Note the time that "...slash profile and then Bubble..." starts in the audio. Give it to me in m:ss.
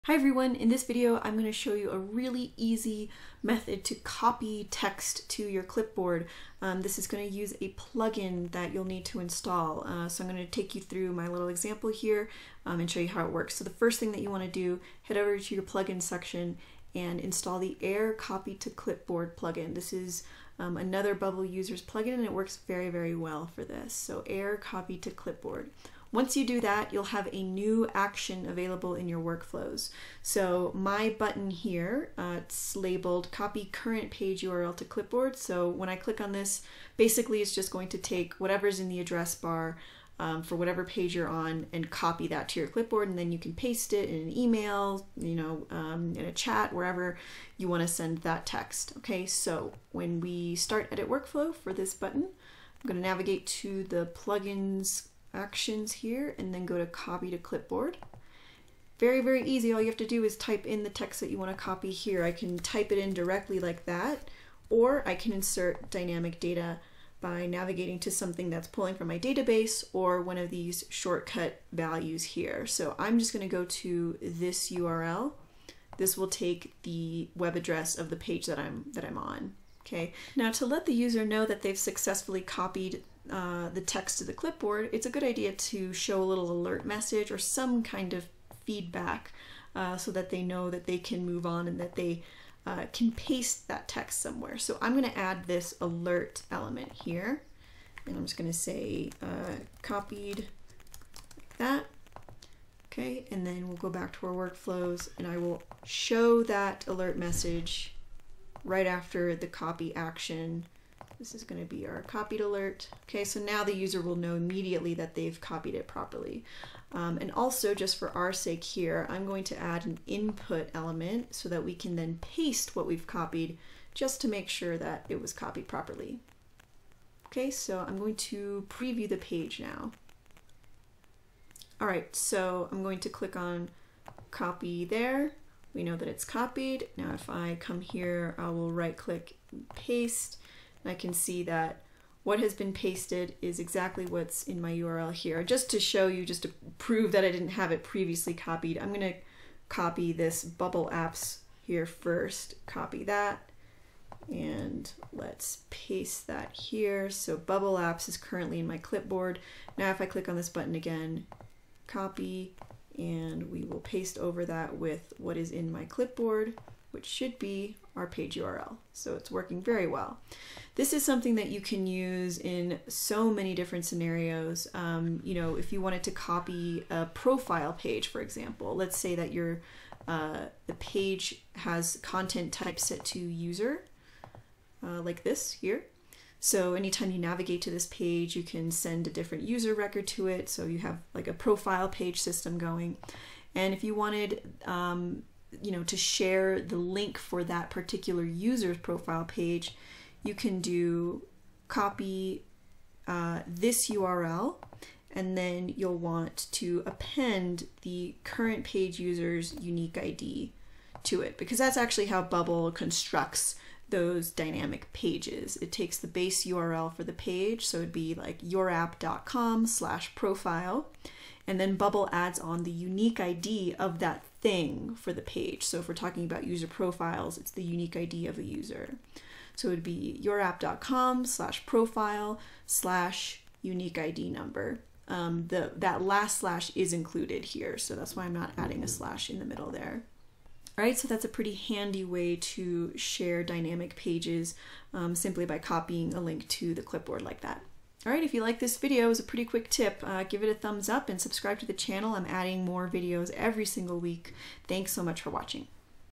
3:39.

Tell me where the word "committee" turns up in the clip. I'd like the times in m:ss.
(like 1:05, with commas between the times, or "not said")
not said.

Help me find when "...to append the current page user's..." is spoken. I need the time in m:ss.
3:26.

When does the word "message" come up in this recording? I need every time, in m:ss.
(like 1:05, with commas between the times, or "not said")
1:26, 1:47.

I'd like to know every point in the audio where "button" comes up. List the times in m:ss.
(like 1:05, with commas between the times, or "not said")
0:31, 0:51, 2:40.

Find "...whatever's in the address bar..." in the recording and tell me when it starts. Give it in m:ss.
0:38.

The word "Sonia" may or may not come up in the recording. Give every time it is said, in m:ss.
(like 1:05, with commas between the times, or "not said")
not said.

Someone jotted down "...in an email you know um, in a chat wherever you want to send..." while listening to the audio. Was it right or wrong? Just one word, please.
right.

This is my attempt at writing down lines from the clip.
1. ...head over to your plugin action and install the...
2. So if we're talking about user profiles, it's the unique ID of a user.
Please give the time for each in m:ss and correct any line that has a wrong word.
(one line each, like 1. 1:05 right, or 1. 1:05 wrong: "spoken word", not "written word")
1. 0:15 wrong: "section", not "action"
2. 3:45 right.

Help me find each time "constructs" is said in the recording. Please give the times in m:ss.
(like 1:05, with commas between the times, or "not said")
3:32.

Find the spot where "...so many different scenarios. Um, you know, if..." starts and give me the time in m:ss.
2:52.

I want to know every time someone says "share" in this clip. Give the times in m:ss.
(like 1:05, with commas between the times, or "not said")
3:15, 4:02.